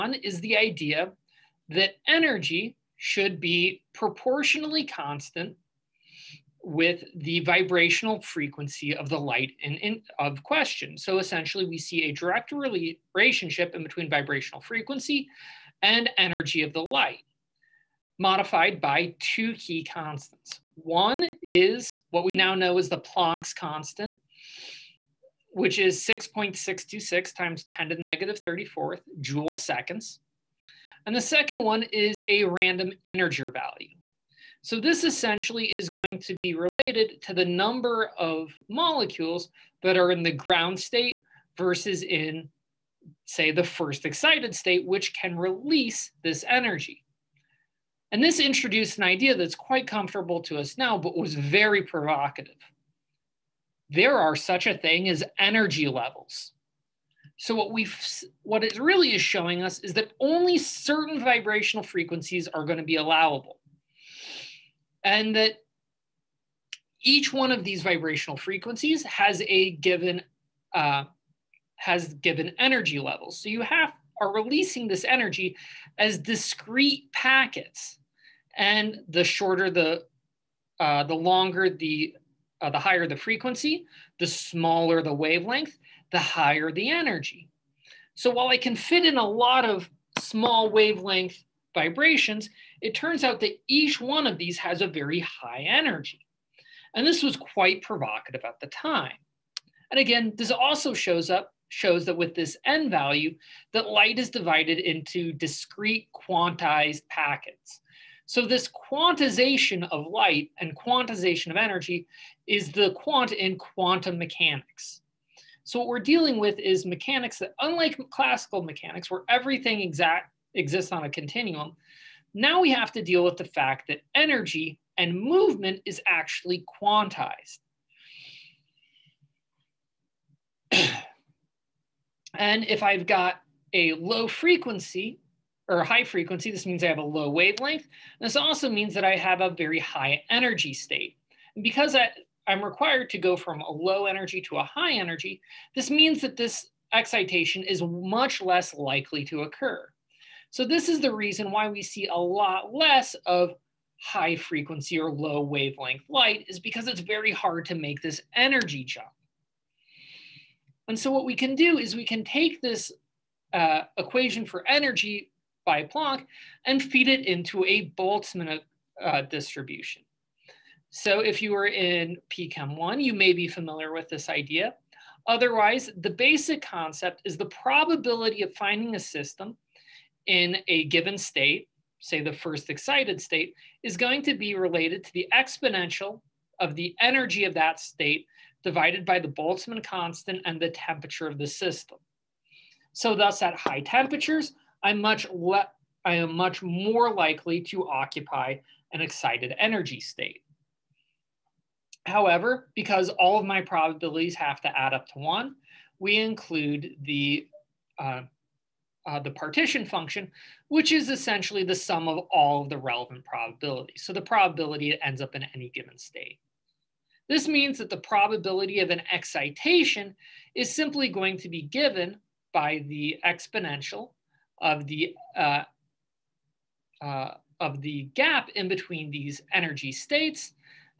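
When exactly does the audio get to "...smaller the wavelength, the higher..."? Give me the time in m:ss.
1:24.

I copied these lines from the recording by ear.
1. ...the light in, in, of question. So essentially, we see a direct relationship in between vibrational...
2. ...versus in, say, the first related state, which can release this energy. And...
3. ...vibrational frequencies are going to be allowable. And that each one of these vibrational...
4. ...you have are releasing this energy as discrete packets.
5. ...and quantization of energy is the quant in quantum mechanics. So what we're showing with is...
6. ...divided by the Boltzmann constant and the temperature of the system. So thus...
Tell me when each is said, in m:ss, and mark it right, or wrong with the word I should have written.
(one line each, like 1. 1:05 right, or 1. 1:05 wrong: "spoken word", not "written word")
1. 0:09 right
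2. 0:41 wrong: "excited", not "related"
3. 1:01 right
4. 1:13 right
5. 1:50 wrong: "dealing", not "showing"
6. 3:08 right.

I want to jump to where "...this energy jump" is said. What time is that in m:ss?
2:38.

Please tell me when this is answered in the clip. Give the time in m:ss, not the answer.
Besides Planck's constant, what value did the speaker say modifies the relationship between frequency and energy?
0:32.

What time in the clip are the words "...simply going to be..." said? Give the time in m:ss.
3:40.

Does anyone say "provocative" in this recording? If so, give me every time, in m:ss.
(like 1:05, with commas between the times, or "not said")
0:51, 1:37.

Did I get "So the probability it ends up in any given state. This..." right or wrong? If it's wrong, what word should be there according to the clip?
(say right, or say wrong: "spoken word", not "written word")
right.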